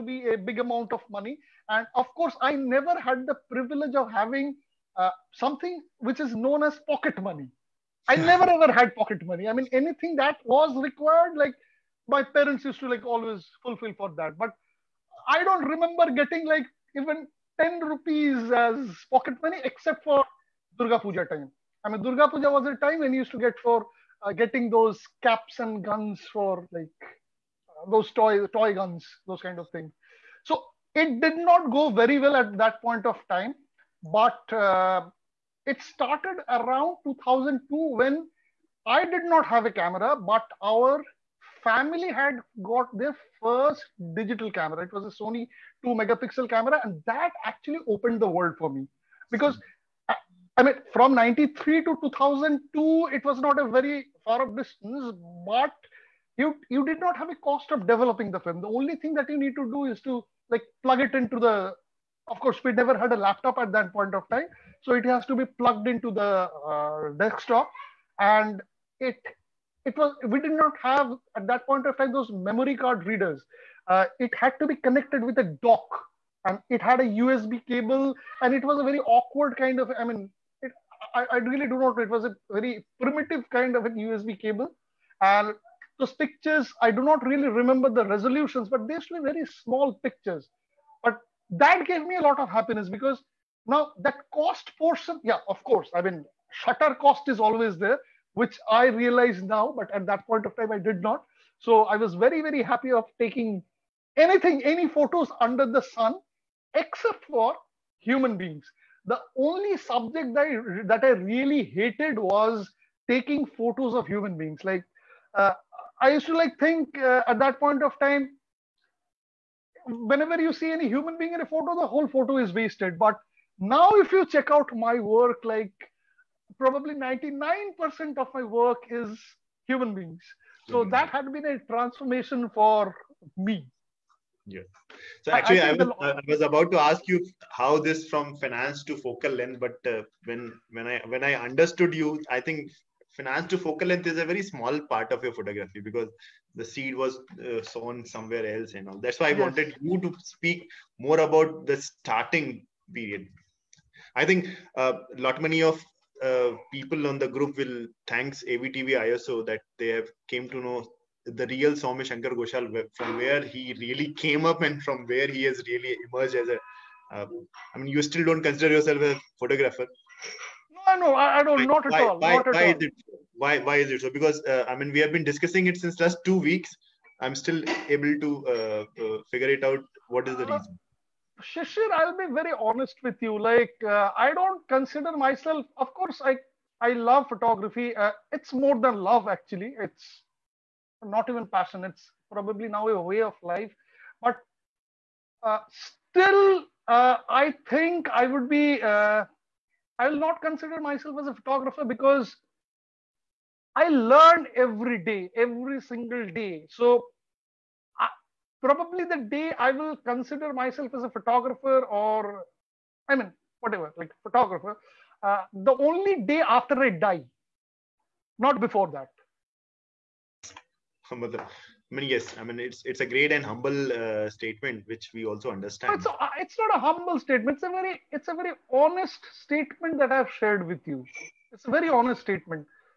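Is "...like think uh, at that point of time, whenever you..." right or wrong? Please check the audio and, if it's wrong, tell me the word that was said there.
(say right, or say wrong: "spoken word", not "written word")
right.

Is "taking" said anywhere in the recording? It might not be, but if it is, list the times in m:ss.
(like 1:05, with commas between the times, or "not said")
1:43, 1:53.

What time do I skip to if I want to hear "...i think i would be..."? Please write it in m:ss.
3:17.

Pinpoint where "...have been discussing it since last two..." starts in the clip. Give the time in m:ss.
2:55.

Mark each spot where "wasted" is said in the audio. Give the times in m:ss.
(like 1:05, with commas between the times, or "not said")
2:02.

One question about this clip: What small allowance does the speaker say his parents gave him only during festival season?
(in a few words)
10 rupees.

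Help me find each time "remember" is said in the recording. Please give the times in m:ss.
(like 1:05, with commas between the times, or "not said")
0:15, 1:27.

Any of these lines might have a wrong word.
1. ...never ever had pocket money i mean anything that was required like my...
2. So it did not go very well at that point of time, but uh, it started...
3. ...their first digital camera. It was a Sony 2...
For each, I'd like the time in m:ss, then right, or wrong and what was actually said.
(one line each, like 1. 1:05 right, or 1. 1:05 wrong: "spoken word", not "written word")
1. 0:08 right
2. 0:30 right
3. 0:42 right.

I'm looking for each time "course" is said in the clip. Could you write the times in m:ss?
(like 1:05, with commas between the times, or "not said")
0:02, 1:02, 1:35, 3:05.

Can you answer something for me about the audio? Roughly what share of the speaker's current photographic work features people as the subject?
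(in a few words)
99%.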